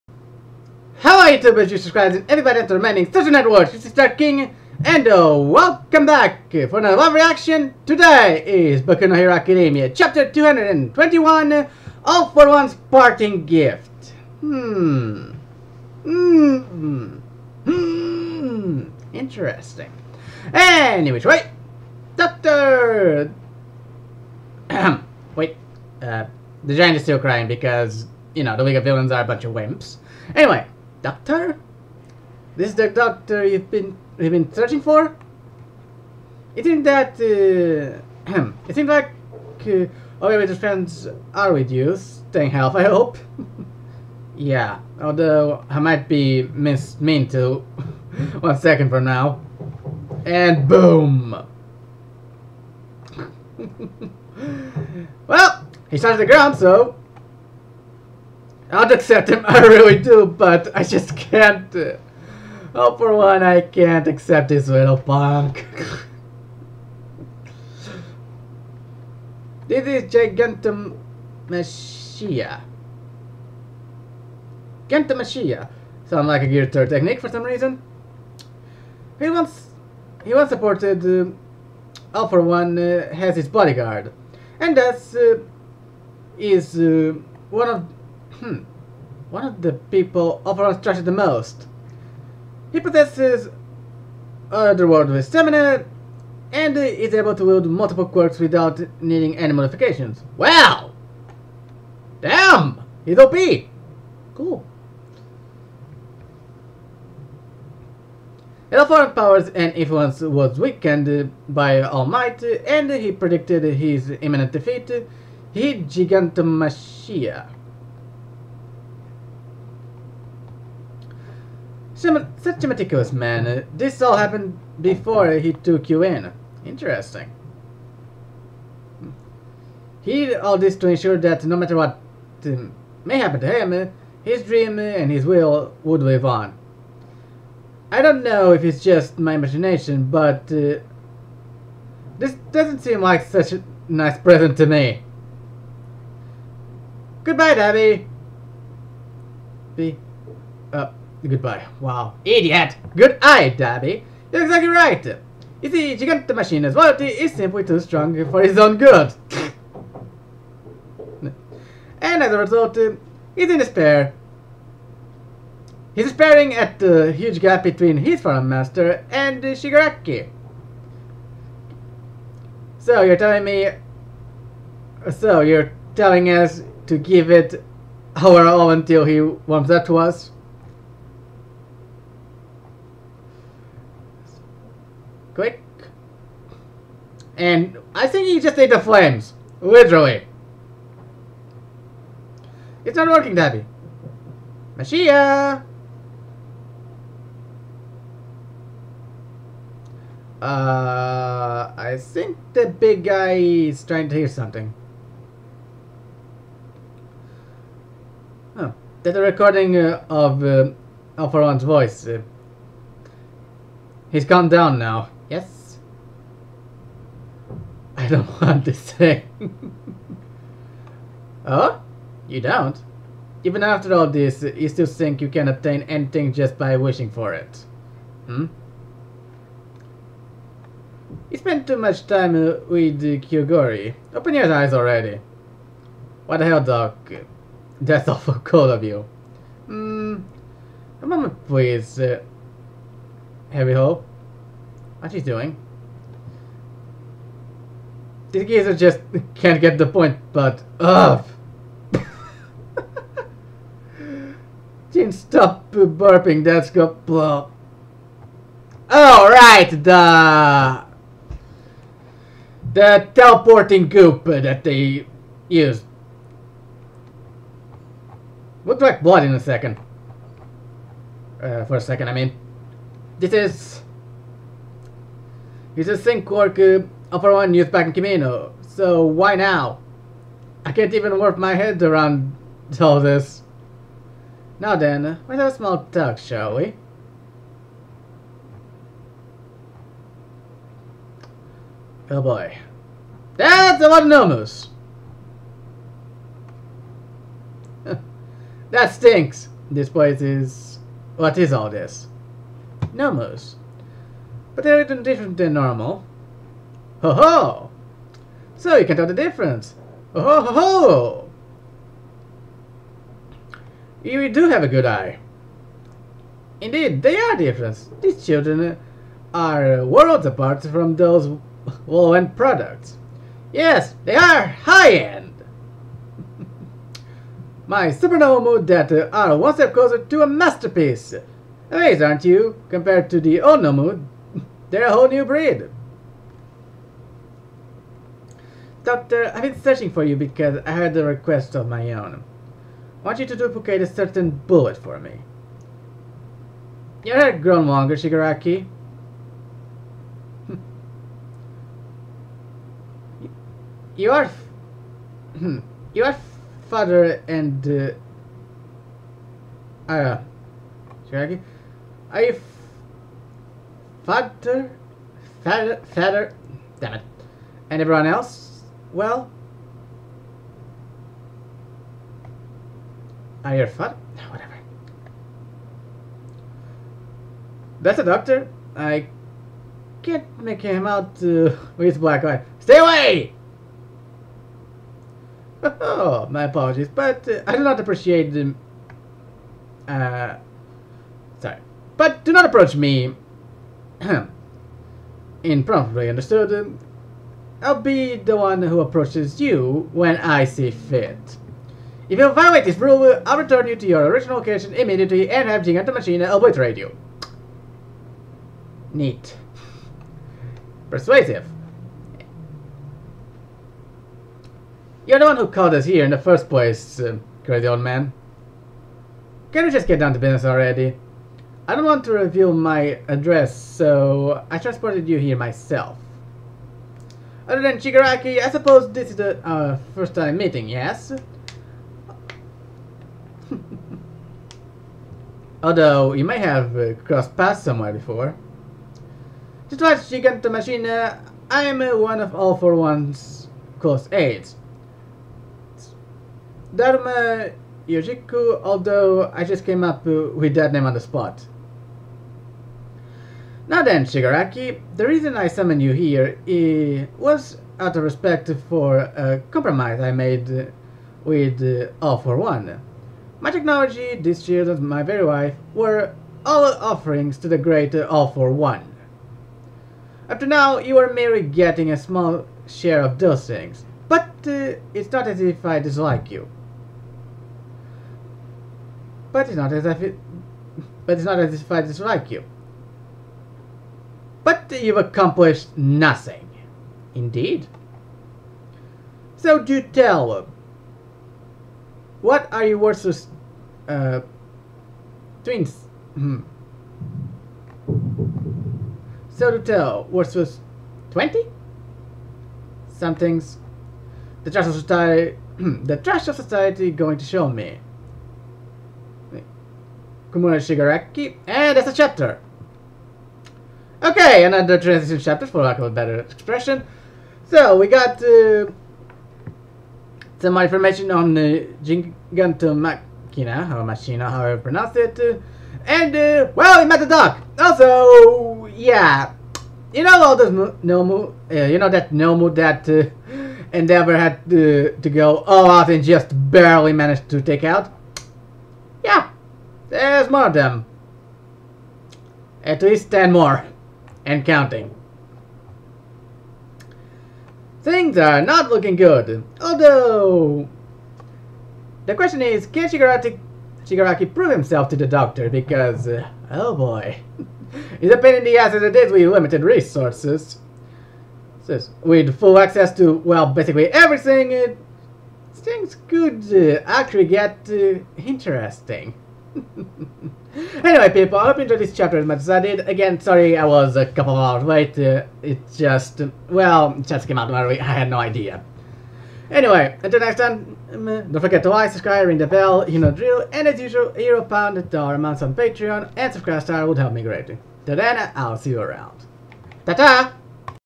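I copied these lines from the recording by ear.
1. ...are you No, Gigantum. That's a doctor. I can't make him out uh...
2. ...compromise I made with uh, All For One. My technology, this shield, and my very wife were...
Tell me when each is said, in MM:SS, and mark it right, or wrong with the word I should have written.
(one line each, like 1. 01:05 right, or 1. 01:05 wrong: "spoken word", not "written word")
1. 06:13 wrong: "Whatever", not "Gigantum"
2. 07:39 right.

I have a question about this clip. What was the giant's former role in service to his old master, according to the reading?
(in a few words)
bodyguard.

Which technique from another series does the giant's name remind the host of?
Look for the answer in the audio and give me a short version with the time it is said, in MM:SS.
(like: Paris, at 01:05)
Gear 3, at 01:16.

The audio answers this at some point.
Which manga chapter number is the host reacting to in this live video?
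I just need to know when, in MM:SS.
00:09.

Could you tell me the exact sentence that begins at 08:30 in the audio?
Tomura Shigaraki, and that's a chapter.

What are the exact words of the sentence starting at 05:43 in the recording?
I want you to duplicate a certain bullet for me.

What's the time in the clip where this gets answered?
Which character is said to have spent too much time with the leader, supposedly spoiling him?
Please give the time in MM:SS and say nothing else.
03:53.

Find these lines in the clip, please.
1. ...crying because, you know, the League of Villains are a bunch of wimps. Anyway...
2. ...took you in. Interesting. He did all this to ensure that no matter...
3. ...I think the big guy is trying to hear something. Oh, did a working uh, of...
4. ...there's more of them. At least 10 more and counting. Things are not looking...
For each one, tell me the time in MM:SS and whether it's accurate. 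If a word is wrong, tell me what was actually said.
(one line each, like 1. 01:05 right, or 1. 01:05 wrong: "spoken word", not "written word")
1. 00:27 right
2. 02:05 right
3. 03:21 wrong: "recording", not "working"
4. 08:59 right.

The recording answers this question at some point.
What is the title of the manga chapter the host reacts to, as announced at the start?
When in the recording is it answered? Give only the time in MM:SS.
00:12.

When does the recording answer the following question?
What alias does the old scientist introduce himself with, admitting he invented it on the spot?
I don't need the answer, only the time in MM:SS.
07:26.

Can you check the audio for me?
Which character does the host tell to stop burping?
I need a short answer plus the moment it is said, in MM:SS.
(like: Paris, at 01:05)
Jin, at 04:14.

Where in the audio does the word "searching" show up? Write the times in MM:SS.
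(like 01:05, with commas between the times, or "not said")
00:34, 05:39.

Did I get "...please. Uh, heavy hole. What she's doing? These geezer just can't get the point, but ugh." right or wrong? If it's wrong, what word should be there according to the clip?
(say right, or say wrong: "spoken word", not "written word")
right.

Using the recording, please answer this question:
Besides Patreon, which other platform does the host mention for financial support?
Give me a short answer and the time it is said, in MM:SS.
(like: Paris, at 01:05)
SubscribeStar, at 09:46.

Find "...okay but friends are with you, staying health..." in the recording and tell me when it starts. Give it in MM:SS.
00:39.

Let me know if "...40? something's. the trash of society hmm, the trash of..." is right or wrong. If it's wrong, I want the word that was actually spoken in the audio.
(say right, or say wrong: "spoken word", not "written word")
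wrong: "20", not "40".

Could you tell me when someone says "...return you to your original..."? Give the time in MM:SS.
06:43.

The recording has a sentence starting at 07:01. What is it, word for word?
I don't want to reveal my address, so I transported you here myself.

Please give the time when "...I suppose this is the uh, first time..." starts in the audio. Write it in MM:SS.
07:08.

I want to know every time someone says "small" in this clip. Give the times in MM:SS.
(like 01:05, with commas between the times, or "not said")
04:45, 07:51.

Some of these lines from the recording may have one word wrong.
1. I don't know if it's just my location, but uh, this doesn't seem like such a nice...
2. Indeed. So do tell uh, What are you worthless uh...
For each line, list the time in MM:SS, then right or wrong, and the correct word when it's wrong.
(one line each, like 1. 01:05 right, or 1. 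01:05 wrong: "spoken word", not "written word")
1. 02:17 wrong: "imagination", not "location"
2. 08:07 right.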